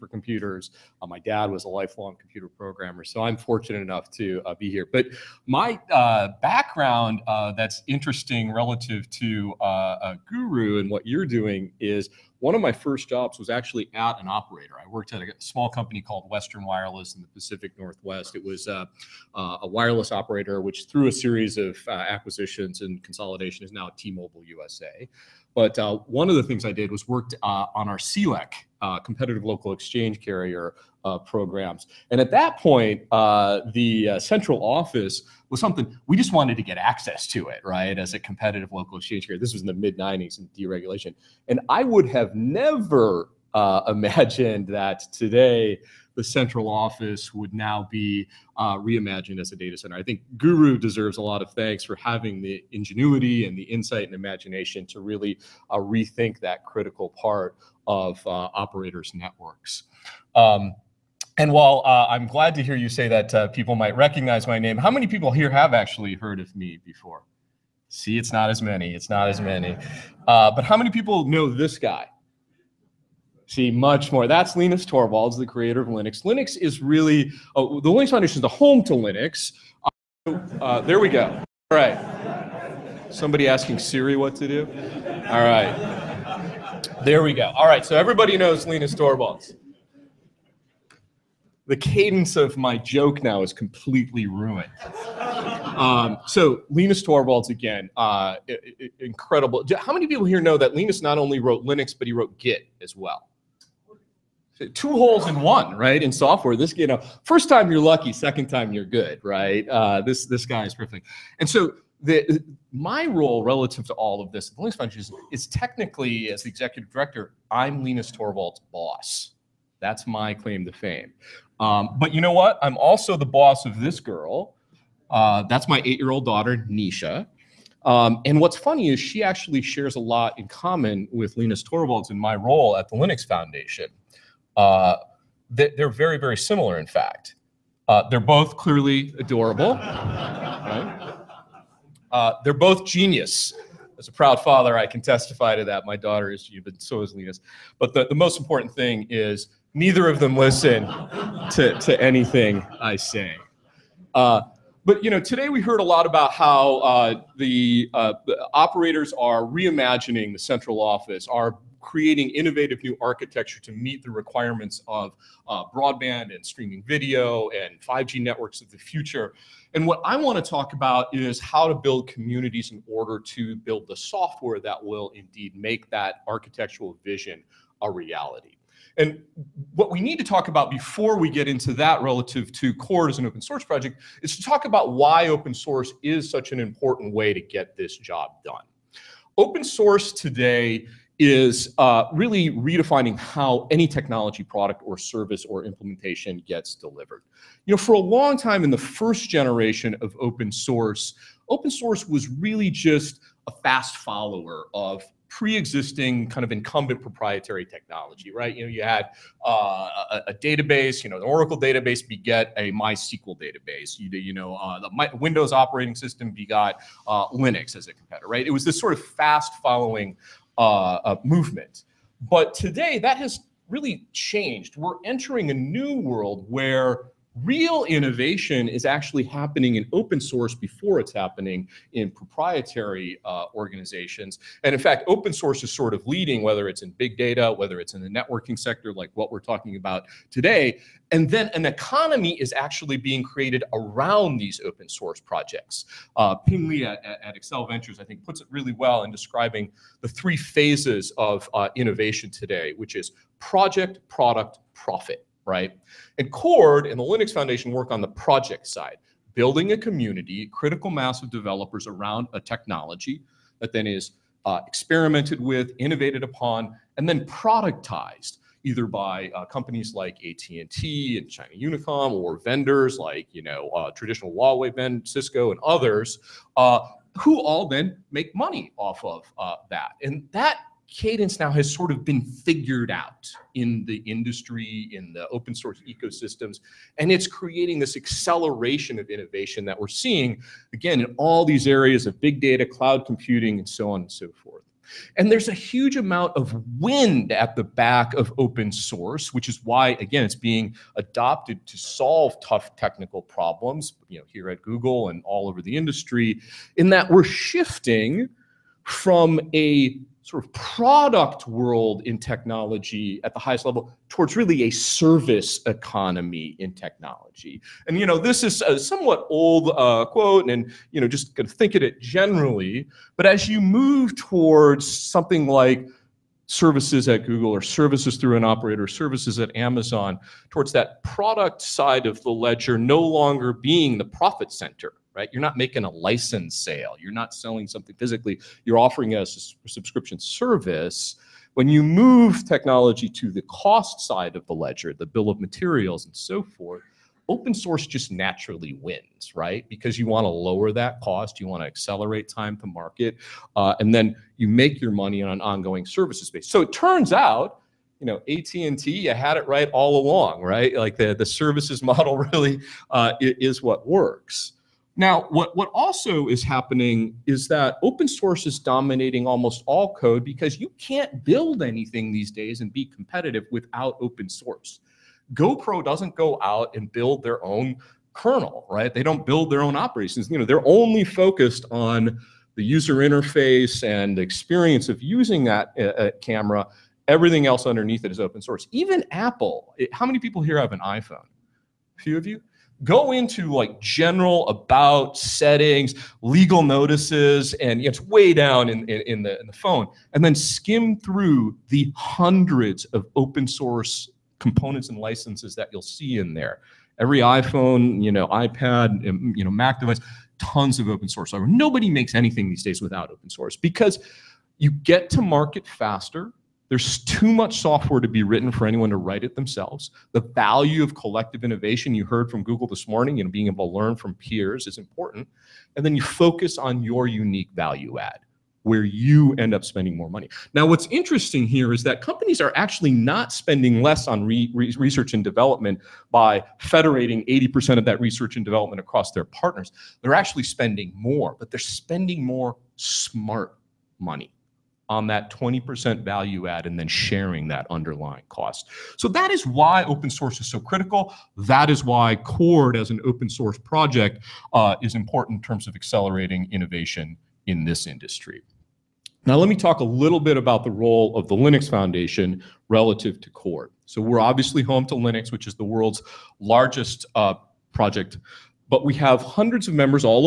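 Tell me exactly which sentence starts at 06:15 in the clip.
GoPro doesn't go out and build their own kernel, right?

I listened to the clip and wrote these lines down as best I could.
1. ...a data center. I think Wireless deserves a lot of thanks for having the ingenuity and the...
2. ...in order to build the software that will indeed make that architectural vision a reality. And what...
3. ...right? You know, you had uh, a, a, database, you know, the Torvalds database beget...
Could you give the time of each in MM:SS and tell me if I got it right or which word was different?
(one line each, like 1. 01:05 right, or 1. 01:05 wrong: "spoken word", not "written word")
1. 00:49 wrong: "Guru", not "Wireless"
2. 02:52 right
3. 03:28 wrong: "Oracle", not "Torvalds".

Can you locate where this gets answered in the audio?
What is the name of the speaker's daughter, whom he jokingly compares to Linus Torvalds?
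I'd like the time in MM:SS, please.
02:06.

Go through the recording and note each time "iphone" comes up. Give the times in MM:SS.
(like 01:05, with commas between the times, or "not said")
06:30, 06:47.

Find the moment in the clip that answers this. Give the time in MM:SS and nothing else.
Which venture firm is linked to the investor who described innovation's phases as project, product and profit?
04:07.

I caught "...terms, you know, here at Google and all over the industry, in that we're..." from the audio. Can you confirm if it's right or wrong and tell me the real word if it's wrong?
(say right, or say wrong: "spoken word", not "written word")
wrong: "problems", not "terms".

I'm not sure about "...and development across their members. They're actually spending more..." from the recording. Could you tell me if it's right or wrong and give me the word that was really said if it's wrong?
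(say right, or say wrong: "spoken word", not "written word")
wrong: "partners", not "members".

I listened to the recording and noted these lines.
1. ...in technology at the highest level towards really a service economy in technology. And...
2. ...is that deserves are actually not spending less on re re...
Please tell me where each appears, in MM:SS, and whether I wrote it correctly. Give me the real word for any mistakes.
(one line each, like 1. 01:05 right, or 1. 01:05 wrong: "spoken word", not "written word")
1. 05:12 right
2. 07:11 wrong: "companies", not "deserves".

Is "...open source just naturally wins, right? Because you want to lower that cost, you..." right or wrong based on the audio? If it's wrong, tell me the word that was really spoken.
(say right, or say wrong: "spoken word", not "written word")
right.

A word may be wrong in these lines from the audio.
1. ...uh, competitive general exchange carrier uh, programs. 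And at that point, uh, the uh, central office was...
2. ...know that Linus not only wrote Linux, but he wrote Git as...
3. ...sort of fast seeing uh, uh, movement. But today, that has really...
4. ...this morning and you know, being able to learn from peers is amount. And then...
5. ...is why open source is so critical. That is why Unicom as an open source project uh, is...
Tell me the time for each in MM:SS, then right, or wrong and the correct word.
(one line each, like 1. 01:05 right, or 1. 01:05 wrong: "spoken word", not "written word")
1. 00:28 wrong: "local", not "general"
2. 01:40 right
3. 03:38 wrong: "following", not "seeing"
4. 07:02 wrong: "important", not "amount"
5. 07:29 wrong: "Cord", not "Unicom".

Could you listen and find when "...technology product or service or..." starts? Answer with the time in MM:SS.
03:13.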